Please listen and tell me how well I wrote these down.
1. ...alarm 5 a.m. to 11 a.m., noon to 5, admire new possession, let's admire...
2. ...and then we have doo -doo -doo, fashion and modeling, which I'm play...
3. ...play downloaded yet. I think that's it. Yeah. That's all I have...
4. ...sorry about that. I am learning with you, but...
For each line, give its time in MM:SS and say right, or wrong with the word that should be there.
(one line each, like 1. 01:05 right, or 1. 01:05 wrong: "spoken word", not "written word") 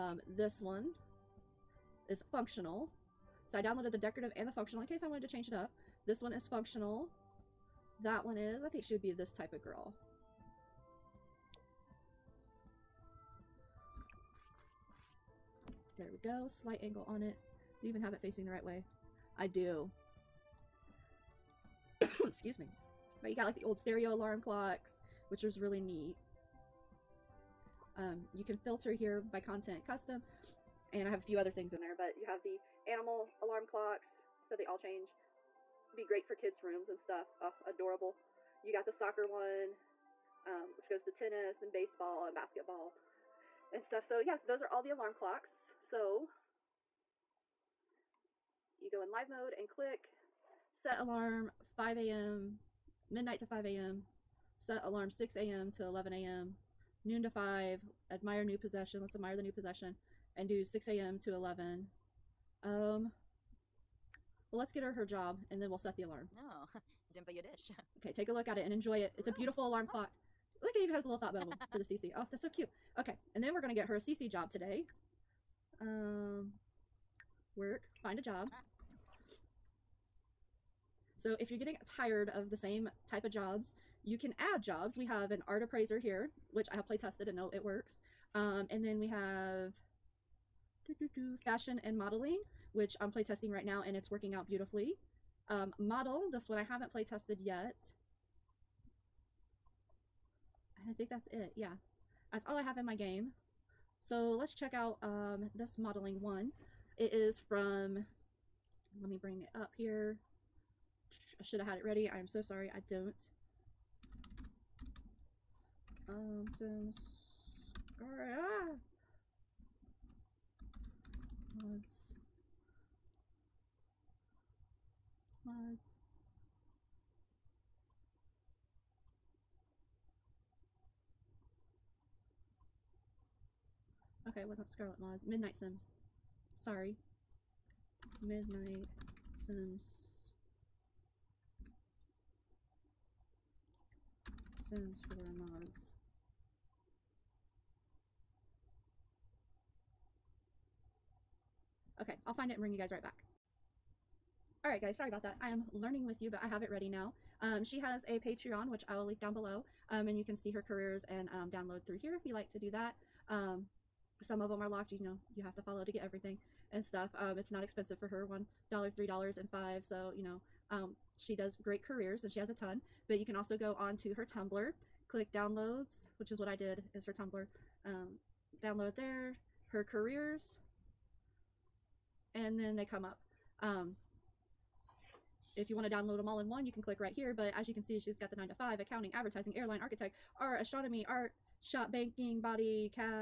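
1. 00:54 wrong: "6", not "5"
2. 01:28 right
3. 01:36 wrong: "tested", not "downloaded"
4. 02:34 right.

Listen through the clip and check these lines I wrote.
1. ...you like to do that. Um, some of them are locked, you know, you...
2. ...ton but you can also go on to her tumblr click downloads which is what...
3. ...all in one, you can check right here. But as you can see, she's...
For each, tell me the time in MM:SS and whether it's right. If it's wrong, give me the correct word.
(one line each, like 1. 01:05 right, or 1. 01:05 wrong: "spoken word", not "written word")
1. 02:42 right
2. 02:52 right
3. 03:06 wrong: "click", not "check".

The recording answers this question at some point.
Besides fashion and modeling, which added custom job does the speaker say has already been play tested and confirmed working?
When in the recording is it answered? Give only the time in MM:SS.
01:25.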